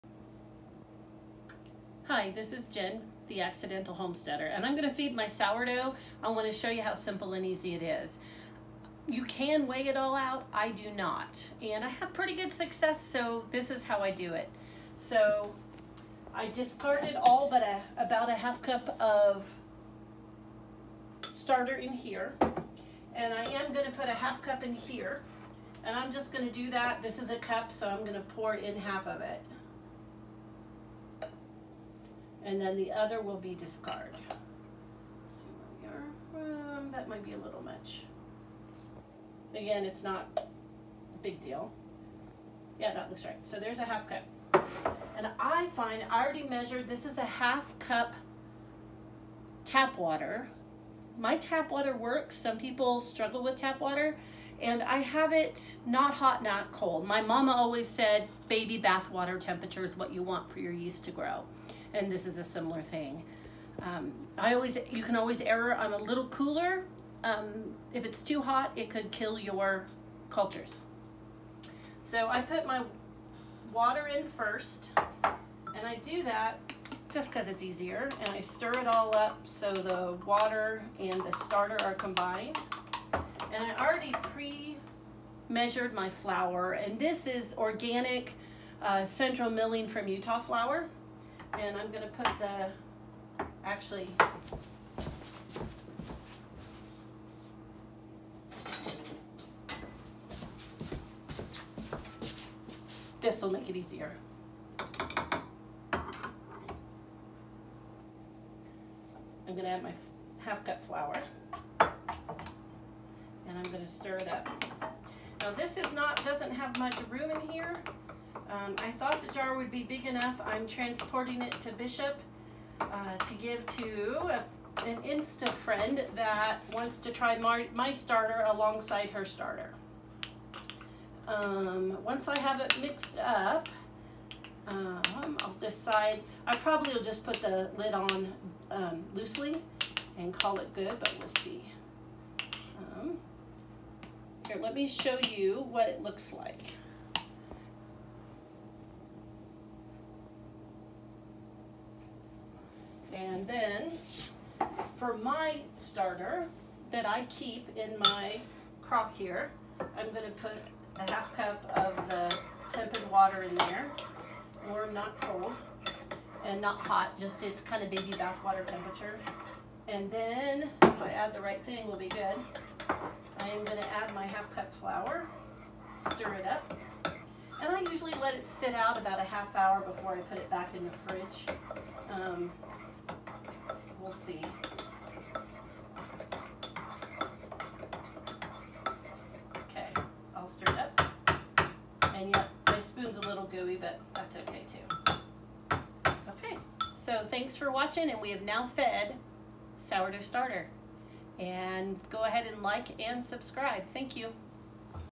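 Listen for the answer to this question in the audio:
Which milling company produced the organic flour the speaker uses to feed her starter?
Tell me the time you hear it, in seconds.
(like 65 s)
89 s.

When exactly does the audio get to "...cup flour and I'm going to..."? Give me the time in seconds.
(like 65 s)
110 s.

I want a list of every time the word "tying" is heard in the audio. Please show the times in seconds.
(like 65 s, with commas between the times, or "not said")
not said.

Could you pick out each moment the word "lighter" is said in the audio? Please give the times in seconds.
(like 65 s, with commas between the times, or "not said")
not said.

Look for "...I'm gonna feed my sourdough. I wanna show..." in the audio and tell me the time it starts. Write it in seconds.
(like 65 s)
4 s.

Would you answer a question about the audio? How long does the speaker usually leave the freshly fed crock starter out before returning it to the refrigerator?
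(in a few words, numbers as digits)
a half hour.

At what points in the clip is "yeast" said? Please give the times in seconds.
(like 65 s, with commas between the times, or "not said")
60 s.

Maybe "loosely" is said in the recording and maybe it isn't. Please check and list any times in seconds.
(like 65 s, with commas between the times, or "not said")
139 s.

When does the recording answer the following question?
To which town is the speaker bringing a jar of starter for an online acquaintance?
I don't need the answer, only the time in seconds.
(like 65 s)
121 s.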